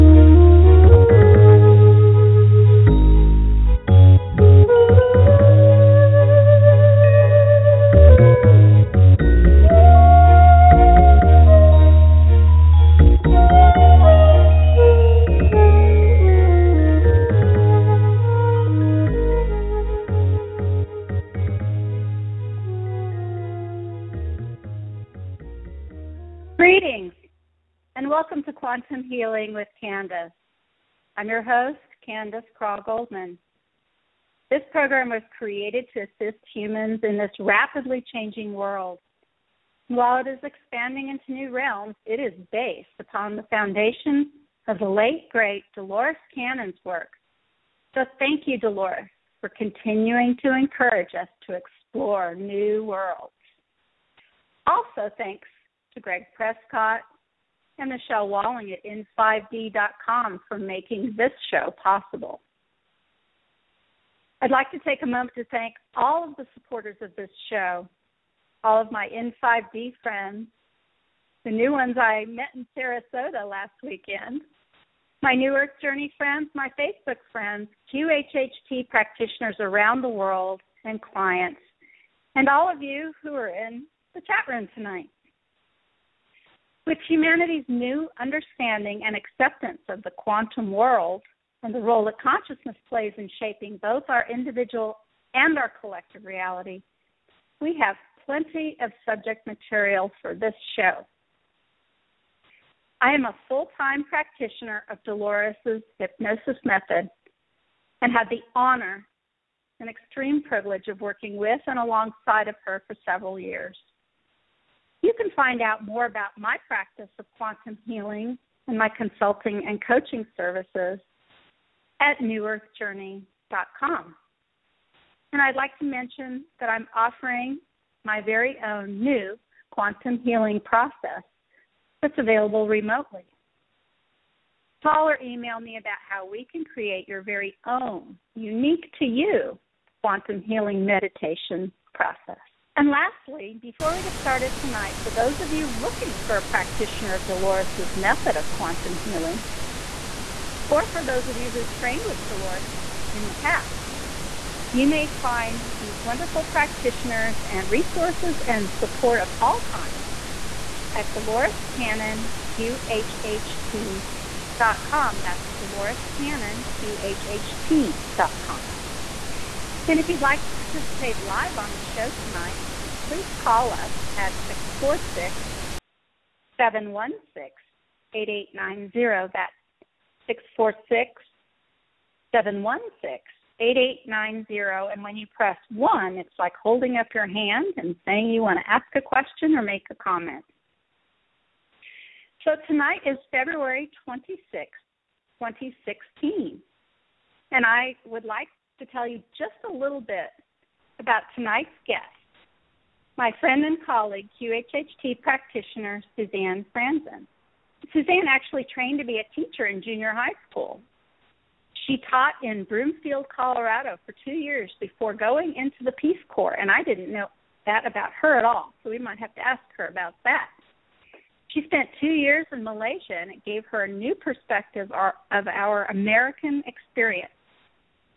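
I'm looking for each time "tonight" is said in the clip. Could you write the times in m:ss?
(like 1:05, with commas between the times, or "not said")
1:24, 2:24, 2:52, 3:12, 3:21.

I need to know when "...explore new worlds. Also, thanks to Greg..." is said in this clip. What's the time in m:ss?
0:51.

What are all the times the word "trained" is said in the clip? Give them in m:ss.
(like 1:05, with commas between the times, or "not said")
2:31, 3:28.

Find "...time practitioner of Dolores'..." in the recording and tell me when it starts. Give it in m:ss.
1:43.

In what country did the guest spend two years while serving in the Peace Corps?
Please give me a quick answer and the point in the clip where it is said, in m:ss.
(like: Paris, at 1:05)
Malaysia, at 3:42.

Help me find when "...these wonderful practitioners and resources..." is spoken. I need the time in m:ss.
2:35.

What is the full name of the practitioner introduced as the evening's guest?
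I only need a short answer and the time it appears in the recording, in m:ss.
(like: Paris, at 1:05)
Suzanne Franzen, at 3:26.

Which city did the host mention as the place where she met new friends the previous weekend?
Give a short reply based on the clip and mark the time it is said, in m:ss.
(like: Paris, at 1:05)
Sarasota, at 1:12.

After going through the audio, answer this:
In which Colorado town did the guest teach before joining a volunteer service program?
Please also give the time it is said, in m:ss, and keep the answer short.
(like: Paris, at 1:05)
Broomfield, at 3:32.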